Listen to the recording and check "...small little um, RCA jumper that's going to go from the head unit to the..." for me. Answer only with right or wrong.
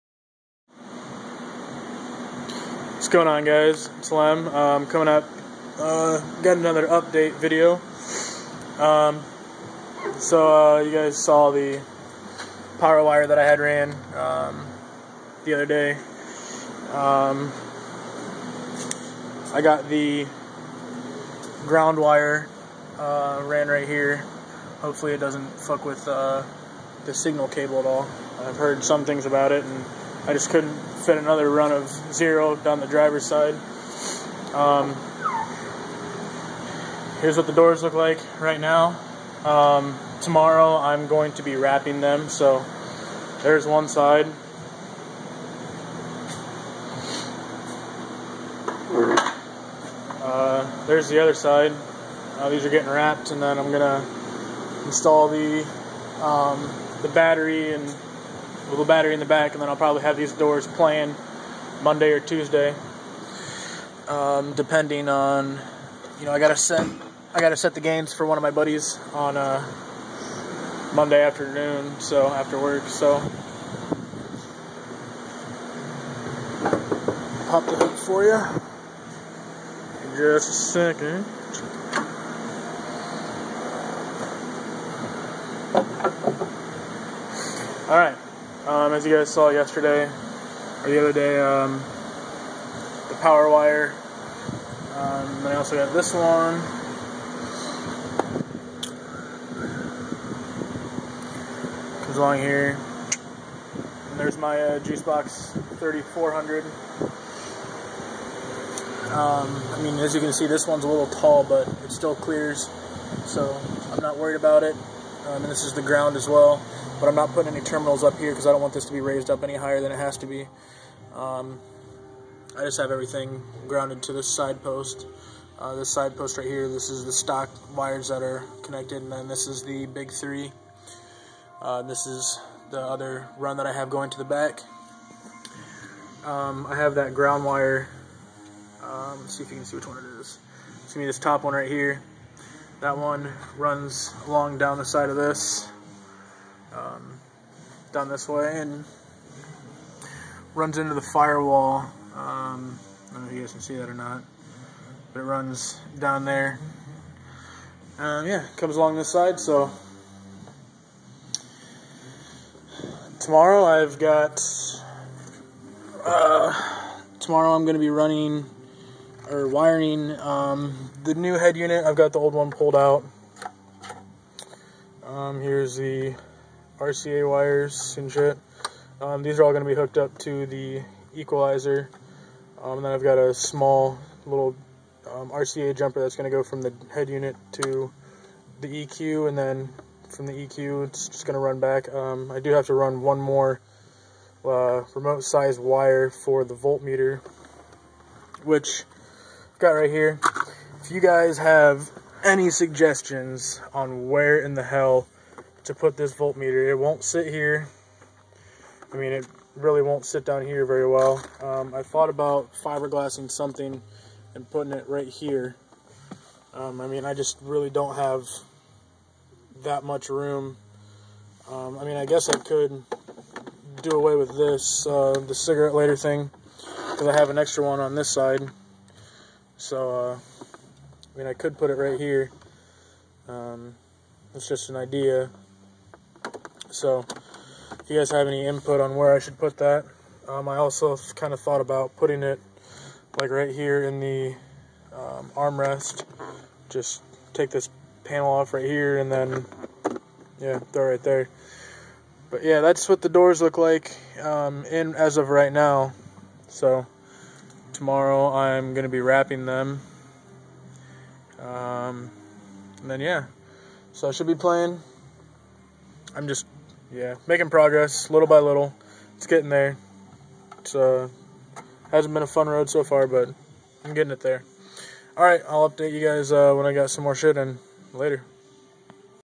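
right.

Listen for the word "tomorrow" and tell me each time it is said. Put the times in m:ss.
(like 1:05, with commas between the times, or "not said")
0:40, 2:43, 2:47, 4:17.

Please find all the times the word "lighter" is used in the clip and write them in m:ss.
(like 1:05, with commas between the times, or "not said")
3:45.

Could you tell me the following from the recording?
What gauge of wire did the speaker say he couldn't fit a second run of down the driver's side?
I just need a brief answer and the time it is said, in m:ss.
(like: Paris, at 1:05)
zero, at 0:32.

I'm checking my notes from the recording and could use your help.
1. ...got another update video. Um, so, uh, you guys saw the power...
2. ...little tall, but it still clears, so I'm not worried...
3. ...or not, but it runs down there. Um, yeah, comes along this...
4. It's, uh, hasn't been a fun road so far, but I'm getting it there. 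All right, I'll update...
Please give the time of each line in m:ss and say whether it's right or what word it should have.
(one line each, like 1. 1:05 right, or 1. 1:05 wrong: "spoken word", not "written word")
1. 0:06 right
2. 1:50 right
3. 2:33 right
4. 4:30 right.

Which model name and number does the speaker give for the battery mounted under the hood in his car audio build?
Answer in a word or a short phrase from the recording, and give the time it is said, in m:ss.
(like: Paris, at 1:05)
Juice Box 3400, at 1:44.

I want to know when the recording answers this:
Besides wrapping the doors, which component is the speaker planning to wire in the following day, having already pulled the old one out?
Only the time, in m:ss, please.
2:51.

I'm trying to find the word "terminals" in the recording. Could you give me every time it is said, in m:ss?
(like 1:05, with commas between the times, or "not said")
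1:57.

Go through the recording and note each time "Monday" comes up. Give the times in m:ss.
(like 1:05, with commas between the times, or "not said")
1:01, 1:10.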